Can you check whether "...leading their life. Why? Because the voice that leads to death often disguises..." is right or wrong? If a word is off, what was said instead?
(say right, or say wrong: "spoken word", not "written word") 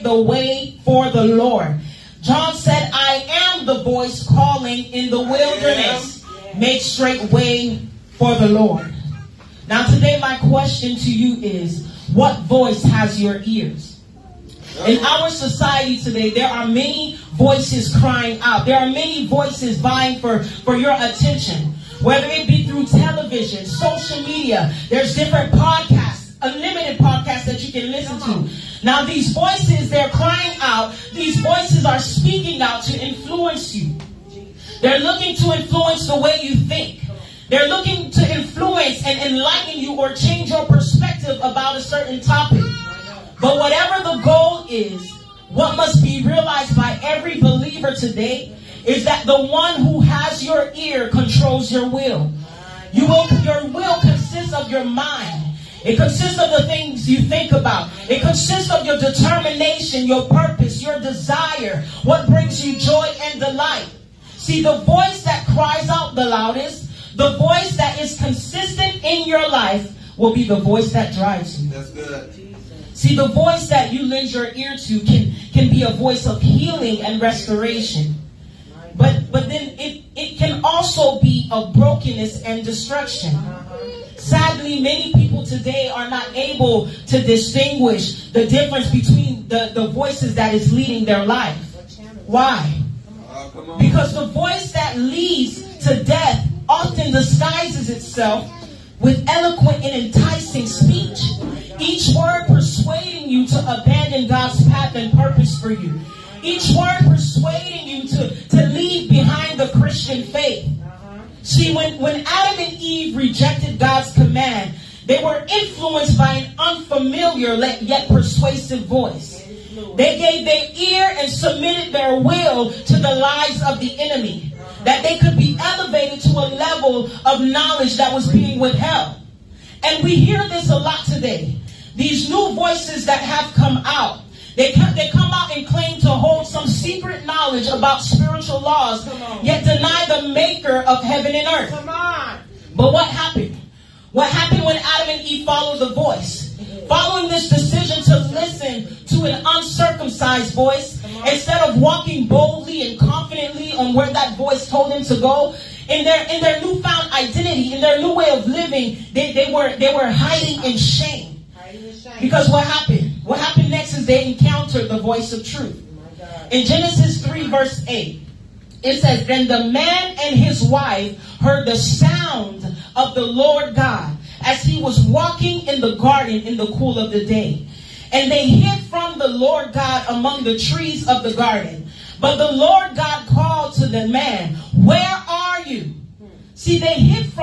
right.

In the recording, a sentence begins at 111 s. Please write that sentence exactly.
See, when, when Adam and Eve rejected God's command, they were influenced by an unfamiliar yet persuasive voice.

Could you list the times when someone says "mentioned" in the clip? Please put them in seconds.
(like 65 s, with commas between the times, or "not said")
not said.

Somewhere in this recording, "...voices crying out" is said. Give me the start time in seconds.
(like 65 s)
17 s.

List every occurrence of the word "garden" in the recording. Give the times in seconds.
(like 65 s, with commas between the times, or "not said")
175 s, 181 s.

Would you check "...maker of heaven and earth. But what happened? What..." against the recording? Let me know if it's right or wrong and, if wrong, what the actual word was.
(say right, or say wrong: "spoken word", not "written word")
right.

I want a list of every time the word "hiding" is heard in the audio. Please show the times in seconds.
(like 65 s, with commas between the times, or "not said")
160 s.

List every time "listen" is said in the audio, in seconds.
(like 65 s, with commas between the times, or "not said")
27 s, 148 s.